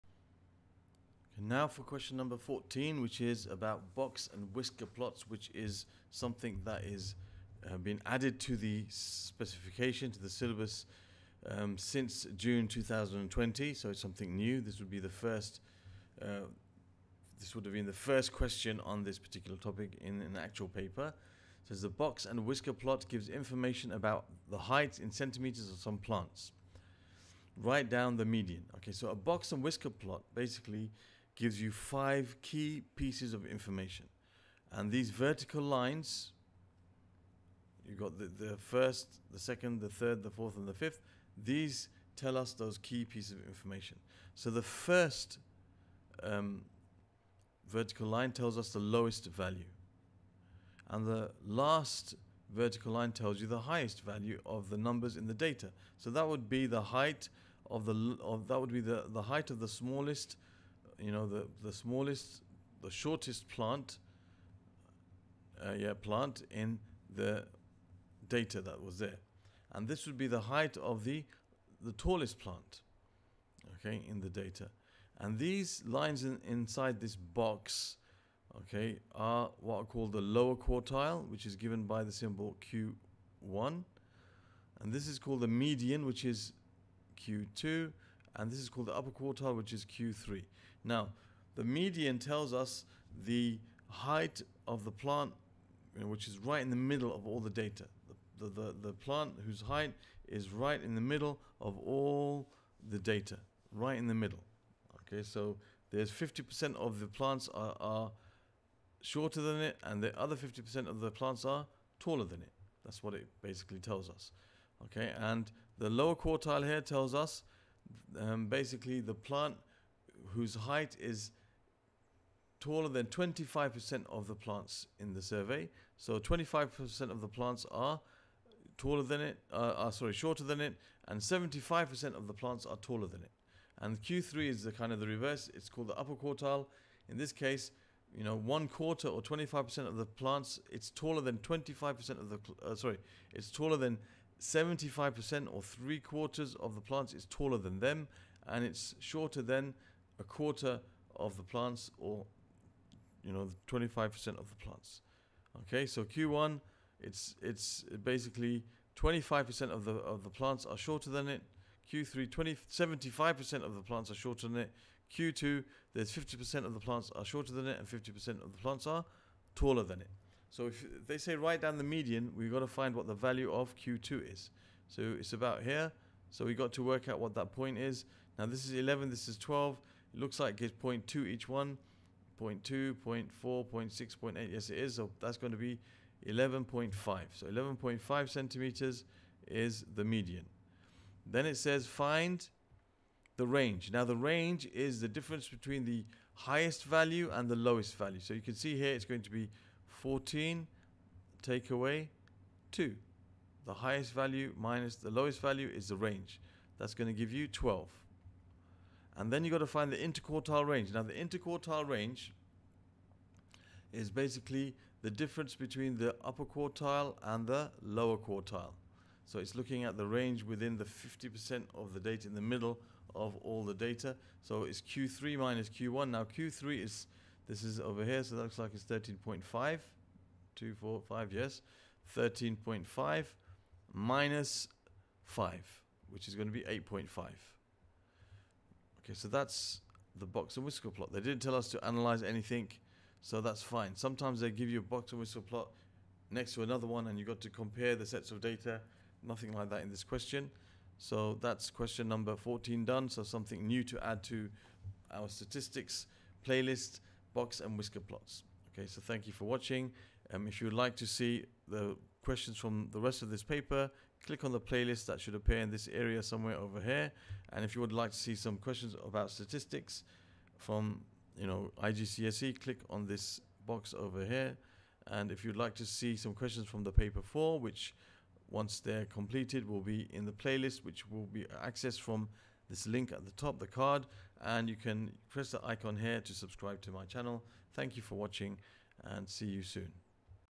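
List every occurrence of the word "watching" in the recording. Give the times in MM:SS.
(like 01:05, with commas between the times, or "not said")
04:19, 04:48.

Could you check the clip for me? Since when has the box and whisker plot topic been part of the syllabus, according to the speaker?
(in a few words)
June 2020.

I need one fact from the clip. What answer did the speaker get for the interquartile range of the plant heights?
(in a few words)
8.5.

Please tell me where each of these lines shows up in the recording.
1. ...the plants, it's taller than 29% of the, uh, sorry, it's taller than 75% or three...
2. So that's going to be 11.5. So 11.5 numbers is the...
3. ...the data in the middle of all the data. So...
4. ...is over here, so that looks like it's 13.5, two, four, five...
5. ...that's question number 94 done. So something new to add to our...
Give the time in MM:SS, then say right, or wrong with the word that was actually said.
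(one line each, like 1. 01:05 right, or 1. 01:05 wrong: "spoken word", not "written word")
1. 02:19 wrong: "25", not "29"
2. 03:04 wrong: "centimeters", not "numbers"
3. 03:41 right
4. 03:47 right
5. 04:11 wrong: "14", not "94".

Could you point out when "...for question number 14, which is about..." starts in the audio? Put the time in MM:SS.
00:01.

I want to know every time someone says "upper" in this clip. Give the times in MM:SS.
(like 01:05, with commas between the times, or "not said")
01:28, 02:15, 03:36.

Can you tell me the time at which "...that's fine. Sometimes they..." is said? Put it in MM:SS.
04:03.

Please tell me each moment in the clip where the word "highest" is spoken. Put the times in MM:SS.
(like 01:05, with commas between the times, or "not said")
00:53, 03:16, 03:23.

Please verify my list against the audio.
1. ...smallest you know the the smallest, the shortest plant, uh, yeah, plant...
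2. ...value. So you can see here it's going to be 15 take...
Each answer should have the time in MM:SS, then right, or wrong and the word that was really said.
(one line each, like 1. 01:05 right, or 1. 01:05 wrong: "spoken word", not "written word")
1. 00:59 right
2. 03:17 wrong: "14", not "15".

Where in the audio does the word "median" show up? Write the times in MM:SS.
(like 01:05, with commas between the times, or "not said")
00:28, 01:25, 01:31, 02:51, 03:10.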